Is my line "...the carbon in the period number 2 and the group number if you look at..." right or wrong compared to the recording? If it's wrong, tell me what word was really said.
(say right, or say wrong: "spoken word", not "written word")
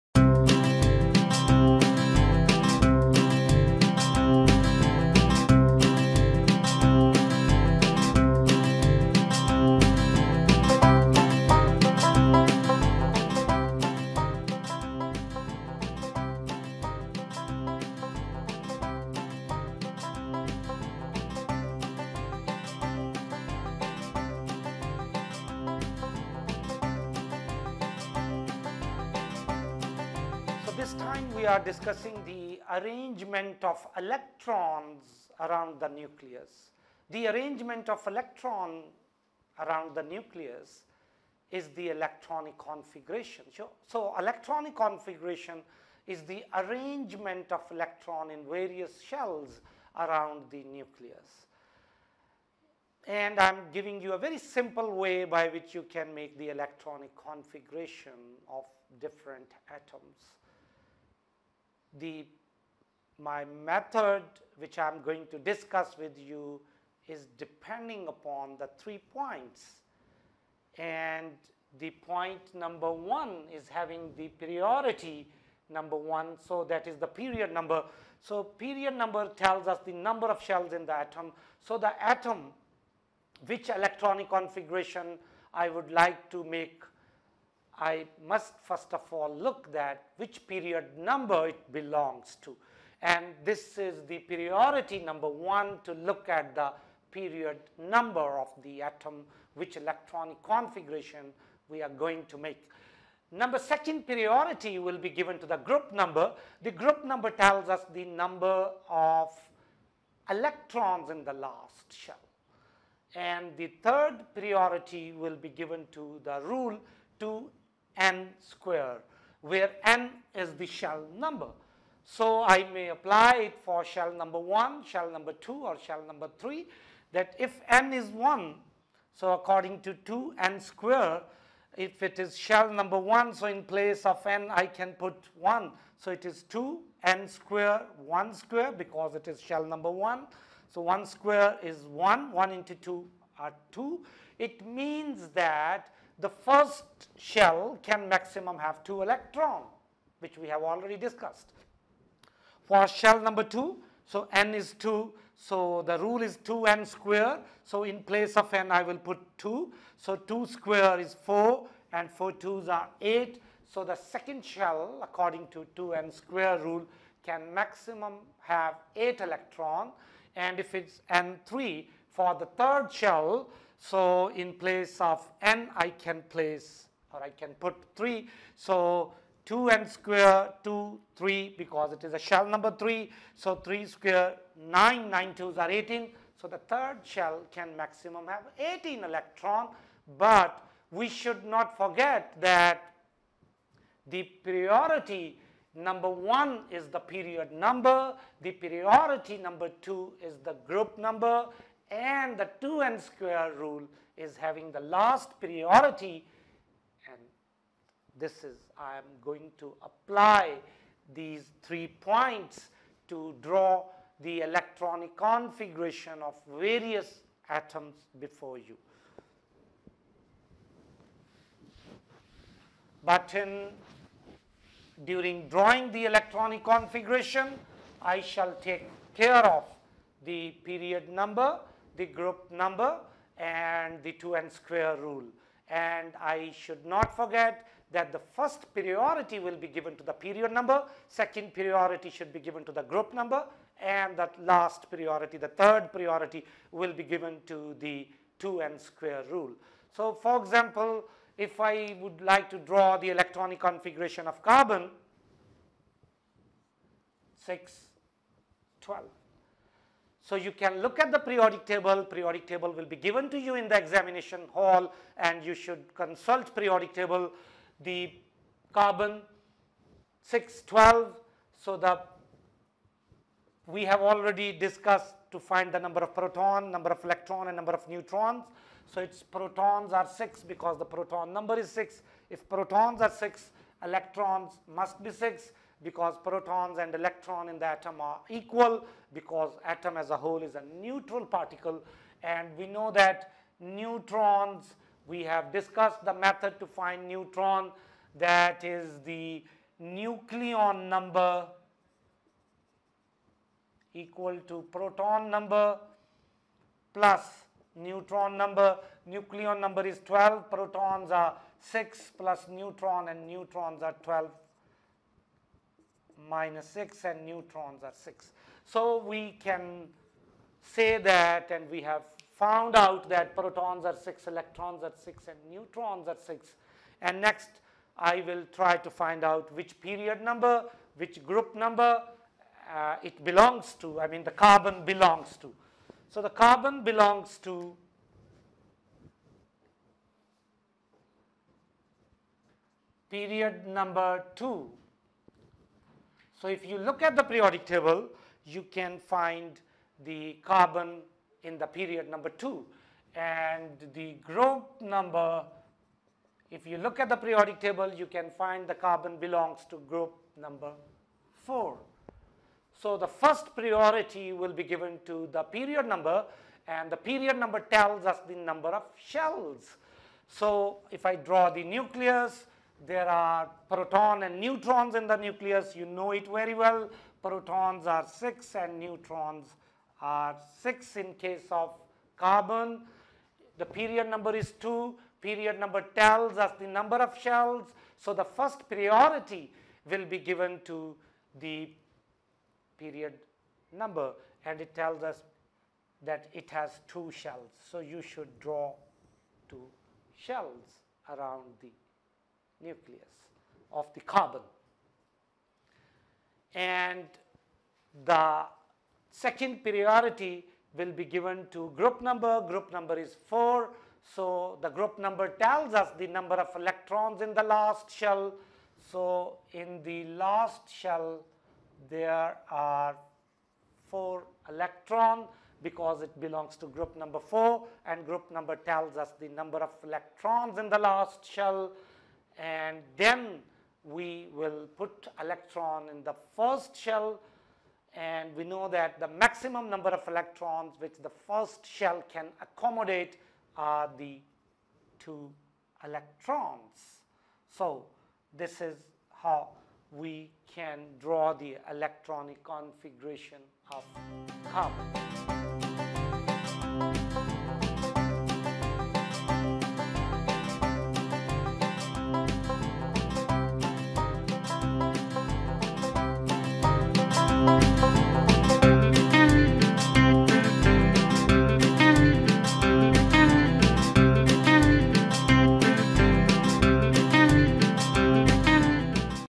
right.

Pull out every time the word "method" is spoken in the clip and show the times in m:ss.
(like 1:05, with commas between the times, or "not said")
1:03, 4:56.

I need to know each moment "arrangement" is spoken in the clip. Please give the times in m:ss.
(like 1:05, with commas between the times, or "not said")
0:32, 0:37, 0:46.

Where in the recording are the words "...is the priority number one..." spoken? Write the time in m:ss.
1:33.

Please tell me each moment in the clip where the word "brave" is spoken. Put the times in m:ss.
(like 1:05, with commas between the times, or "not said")
not said.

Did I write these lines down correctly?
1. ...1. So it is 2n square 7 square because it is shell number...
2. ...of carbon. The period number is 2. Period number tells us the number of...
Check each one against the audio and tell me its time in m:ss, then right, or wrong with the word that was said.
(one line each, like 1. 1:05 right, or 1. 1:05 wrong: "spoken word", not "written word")
1. 2:15 wrong: "1", not "7"
2. 6:21 right.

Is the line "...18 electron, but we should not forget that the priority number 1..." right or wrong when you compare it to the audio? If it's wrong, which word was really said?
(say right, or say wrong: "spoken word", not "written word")
right.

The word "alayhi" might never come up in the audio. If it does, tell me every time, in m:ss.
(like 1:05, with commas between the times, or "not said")
not said.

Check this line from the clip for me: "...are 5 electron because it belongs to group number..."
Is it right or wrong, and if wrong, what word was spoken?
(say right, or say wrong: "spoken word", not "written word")
wrong: "4", not "5".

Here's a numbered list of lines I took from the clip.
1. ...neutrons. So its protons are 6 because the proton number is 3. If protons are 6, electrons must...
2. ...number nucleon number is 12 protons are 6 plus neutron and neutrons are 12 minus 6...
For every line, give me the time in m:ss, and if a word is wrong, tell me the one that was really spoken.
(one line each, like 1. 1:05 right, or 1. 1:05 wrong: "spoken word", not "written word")
1. 4:37 wrong: "6", not "3"
2. 5:08 right.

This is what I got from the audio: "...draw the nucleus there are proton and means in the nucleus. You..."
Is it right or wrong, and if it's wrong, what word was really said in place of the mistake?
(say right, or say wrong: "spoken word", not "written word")
wrong: "neutrons", not "means".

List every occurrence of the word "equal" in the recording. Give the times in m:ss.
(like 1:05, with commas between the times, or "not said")
4:48, 5:03.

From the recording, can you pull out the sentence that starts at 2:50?
And if it's n3, for the third shell, so in place of n, I can place or I can put 3.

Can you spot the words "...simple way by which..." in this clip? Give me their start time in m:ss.
0:54.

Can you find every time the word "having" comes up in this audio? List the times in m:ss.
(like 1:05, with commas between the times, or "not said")
1:13, 3:24.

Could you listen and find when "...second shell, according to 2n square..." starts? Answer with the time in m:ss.
2:43.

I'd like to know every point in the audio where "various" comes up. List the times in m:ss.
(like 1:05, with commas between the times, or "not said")
0:48, 3:36.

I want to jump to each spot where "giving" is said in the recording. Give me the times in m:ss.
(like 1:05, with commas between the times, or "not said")
0:53.